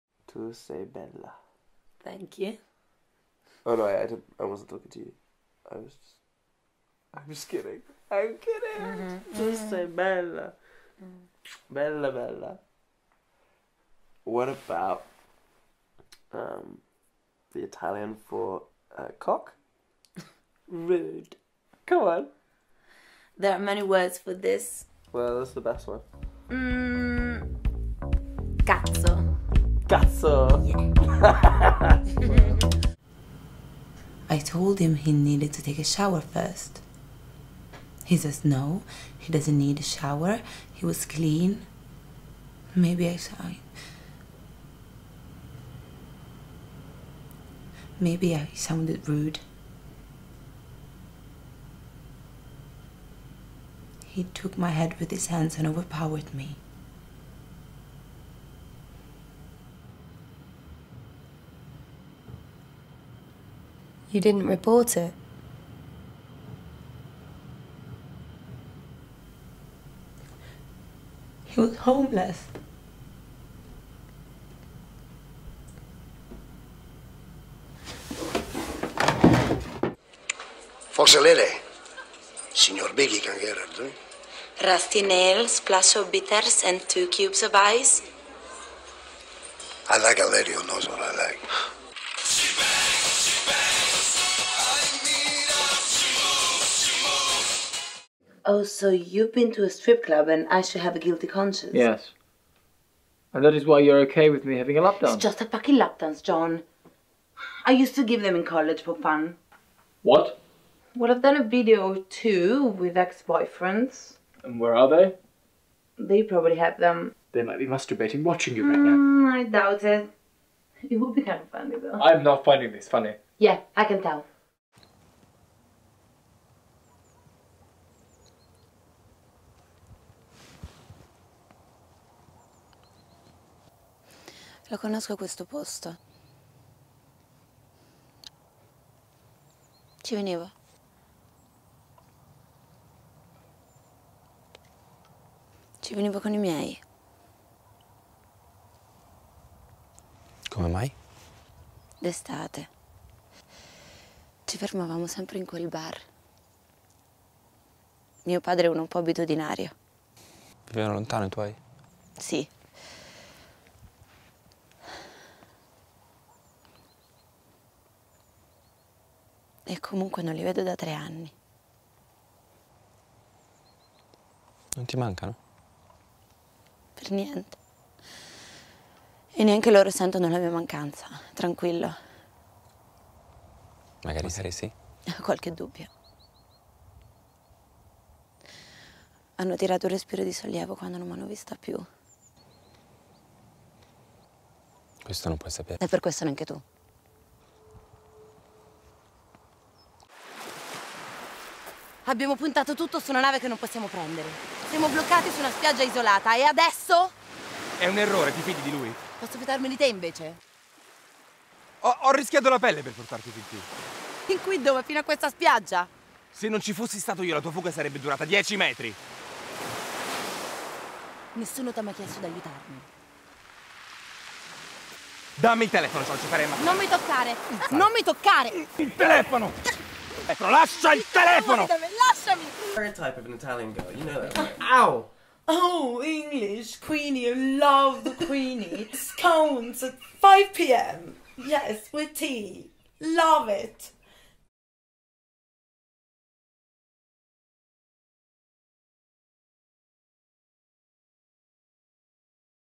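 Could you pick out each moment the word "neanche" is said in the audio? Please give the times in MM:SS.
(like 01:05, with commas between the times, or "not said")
02:59, 03:16.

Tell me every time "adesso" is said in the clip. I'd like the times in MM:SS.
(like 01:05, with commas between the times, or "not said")
03:26.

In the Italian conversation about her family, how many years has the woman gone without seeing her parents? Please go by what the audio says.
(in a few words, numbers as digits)
3.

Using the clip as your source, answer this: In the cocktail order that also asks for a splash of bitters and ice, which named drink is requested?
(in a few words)
Rusty nails.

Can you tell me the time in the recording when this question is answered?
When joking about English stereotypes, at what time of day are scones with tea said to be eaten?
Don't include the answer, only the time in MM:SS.
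04:00.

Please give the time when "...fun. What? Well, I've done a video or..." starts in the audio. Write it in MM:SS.
01:48.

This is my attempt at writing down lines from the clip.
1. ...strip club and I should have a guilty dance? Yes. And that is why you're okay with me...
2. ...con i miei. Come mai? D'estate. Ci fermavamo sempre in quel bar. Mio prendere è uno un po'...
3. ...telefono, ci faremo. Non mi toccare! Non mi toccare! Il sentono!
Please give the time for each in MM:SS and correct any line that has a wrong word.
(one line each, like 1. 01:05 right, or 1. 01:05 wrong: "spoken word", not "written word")
1. 01:39 wrong: "conscience", not "dance"
2. 02:26 wrong: "padre", not "prendere"
3. 03:45 wrong: "telefono", not "sentono".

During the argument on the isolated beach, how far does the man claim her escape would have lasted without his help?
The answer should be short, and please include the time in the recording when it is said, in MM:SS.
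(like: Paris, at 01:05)
10 metres, at 03:38.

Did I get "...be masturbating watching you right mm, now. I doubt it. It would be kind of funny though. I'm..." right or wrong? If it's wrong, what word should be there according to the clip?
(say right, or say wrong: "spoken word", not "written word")
right.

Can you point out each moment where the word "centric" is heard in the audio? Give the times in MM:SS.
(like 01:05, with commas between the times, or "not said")
not said.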